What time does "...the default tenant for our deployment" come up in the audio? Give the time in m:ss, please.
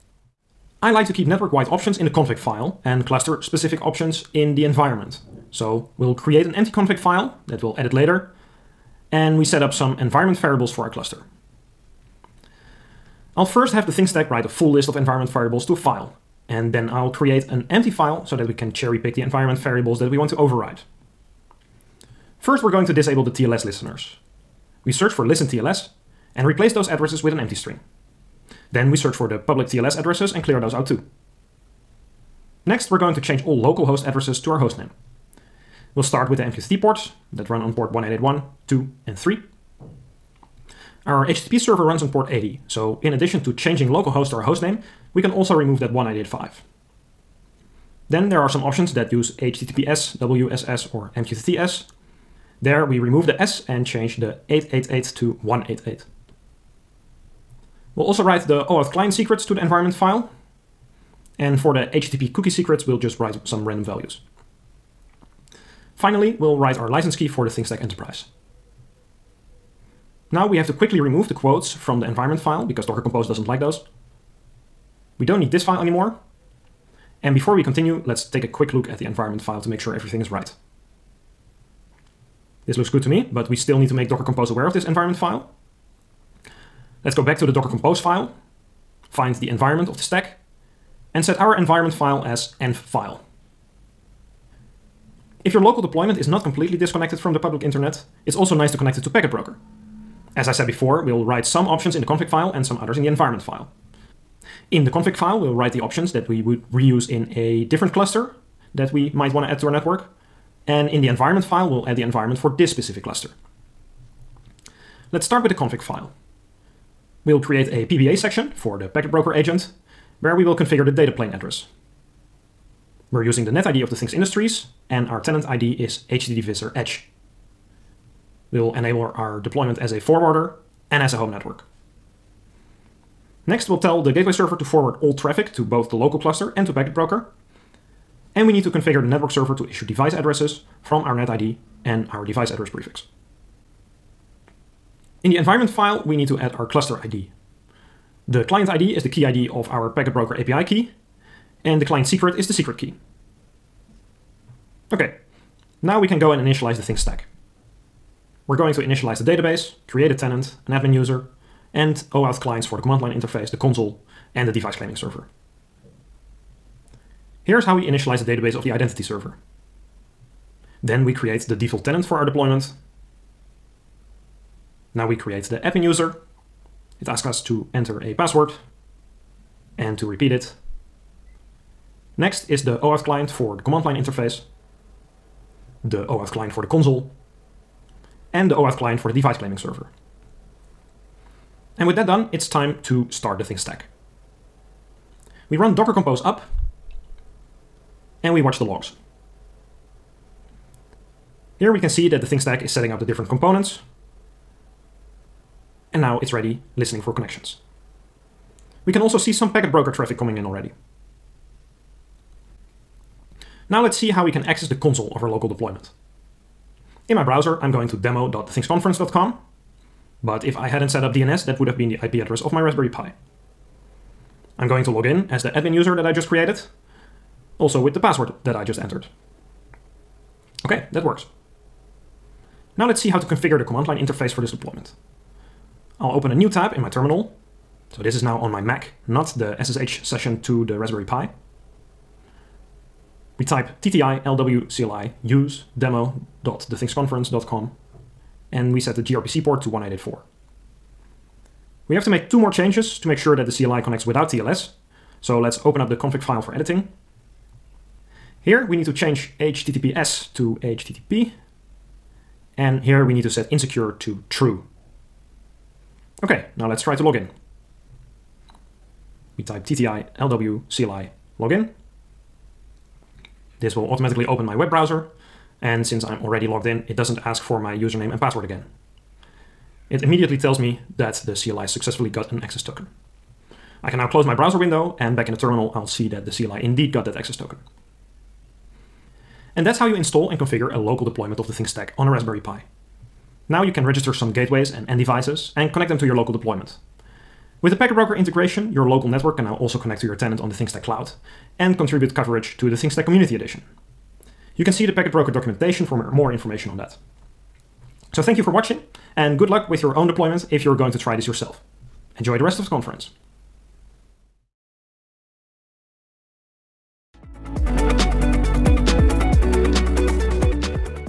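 2:51.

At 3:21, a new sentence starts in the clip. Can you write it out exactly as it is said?
Here we can see that the things Stack is setting up the different components.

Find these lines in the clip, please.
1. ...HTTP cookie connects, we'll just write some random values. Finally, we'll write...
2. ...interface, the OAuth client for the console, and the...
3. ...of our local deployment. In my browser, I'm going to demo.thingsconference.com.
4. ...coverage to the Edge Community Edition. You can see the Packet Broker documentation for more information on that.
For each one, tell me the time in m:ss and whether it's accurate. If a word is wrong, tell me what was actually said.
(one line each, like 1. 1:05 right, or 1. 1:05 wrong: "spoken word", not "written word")
1. 1:01 wrong: "secrets", not "connects"
2. 3:03 right
3. 3:35 right
4. 5:02 wrong: "ThingStack", not "Edge".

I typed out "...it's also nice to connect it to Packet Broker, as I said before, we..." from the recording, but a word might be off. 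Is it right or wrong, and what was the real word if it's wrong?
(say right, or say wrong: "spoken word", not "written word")
right.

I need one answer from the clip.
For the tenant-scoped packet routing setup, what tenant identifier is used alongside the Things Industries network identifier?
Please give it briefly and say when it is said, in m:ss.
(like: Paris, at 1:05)
HTTPvisor Edge, at 2:06.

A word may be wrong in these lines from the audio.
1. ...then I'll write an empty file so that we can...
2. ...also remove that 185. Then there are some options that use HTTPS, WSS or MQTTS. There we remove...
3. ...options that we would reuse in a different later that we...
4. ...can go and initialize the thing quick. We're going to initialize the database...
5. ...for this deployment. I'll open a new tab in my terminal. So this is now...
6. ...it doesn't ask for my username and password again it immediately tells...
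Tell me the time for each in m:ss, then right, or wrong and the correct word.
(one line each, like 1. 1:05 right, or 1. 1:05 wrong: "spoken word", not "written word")
1. 0:16 wrong: "create", not "write"
2. 0:45 right
3. 1:45 wrong: "cluster", not "later"
4. 2:36 wrong: "stack", not "quick"
5. 3:54 right
6. 4:36 right.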